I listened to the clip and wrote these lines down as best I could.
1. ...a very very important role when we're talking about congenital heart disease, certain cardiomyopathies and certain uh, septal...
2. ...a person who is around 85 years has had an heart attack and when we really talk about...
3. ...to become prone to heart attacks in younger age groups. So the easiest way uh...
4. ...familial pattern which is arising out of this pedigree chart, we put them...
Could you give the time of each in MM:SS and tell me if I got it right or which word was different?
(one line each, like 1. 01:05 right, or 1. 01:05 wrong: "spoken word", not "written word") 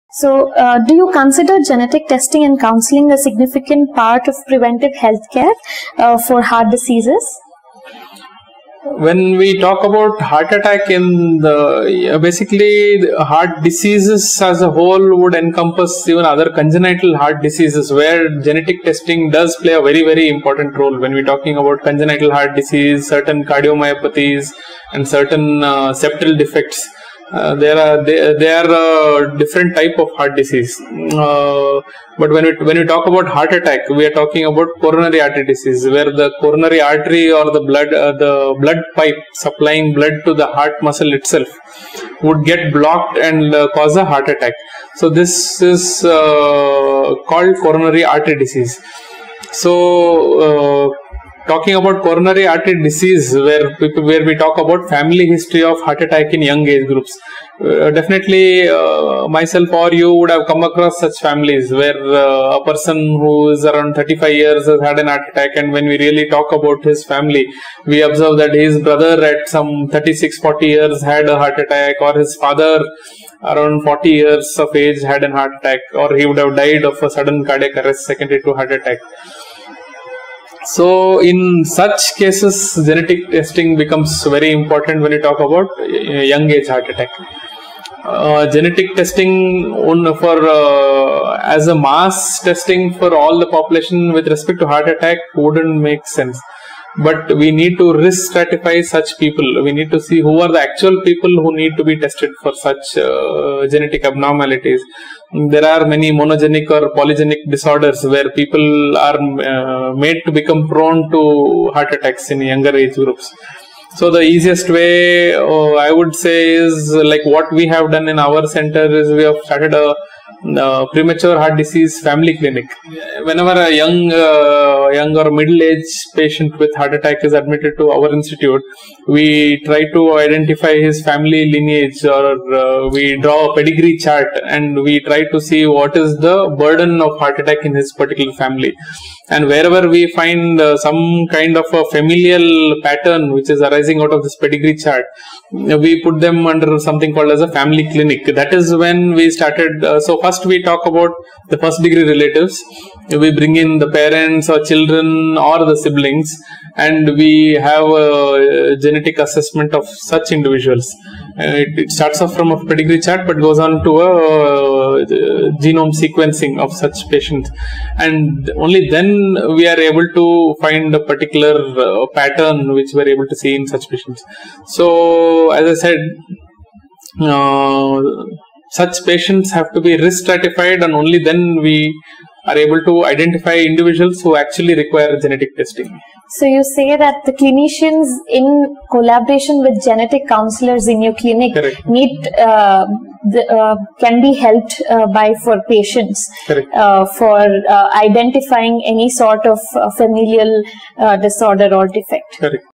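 1. 00:19 right
2. 01:02 wrong: "35", not "85"
3. 01:50 right
4. 02:21 right.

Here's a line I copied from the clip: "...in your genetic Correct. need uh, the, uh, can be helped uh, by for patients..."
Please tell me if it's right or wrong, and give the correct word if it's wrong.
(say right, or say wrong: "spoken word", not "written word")
wrong: "clinic", not "genetic".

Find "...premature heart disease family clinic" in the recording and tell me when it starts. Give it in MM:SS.
02:00.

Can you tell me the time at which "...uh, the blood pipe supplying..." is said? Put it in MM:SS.
00:37.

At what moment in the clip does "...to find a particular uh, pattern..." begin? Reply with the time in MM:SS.
02:50.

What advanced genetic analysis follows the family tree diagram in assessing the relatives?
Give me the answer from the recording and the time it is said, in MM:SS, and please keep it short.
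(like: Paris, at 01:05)
genome sequencing, at 02:45.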